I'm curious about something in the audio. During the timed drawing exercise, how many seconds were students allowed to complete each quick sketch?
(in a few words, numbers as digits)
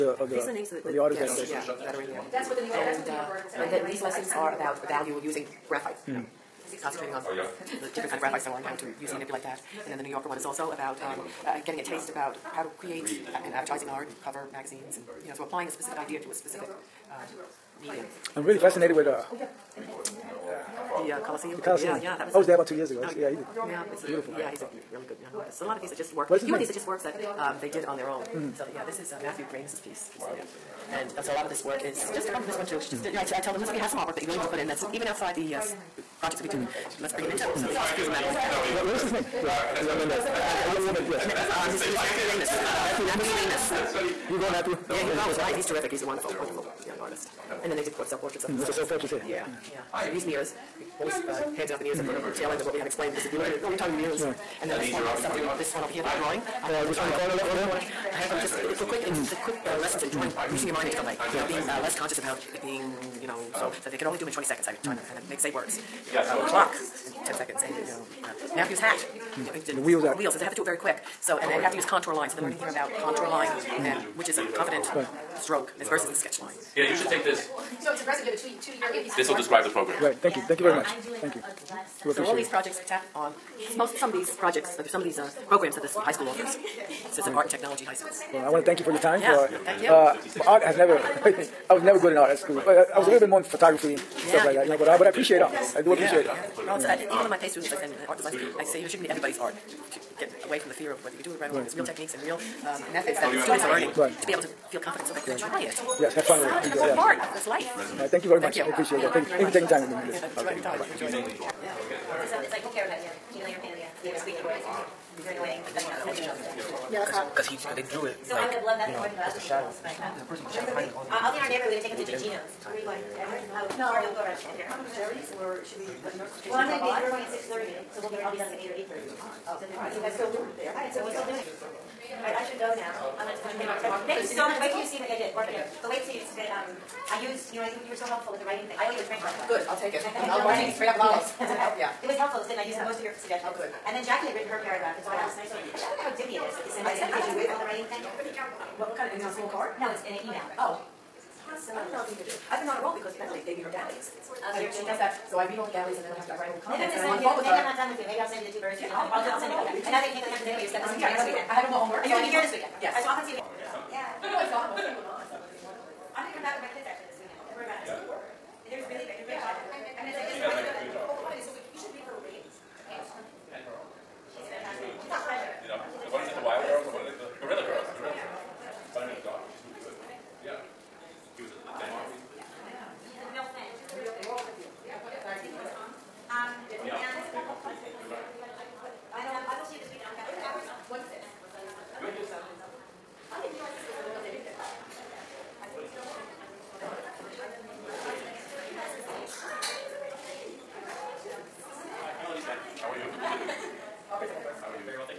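20.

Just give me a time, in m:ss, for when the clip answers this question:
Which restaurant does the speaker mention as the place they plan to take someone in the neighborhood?
2:01.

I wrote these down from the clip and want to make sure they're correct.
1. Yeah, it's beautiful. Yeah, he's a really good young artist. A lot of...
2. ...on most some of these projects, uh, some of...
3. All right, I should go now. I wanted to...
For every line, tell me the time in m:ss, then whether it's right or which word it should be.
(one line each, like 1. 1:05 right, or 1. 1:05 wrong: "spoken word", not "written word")
1. 0:23 right
2. 1:23 right
3. 2:11 right.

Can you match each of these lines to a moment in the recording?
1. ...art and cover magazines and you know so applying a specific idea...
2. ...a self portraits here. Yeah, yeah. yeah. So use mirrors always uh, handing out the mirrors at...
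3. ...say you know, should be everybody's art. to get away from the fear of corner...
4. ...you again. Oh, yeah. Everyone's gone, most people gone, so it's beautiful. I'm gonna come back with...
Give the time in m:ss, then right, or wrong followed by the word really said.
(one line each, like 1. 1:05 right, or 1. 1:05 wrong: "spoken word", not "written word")
1. 0:13 right
2. 0:48 right
3. 1:38 wrong: "whether", not "corner"
4. 2:43 wrong: "wonderful", not "beautiful".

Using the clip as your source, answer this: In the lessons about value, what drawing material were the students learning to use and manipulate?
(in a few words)
graphite.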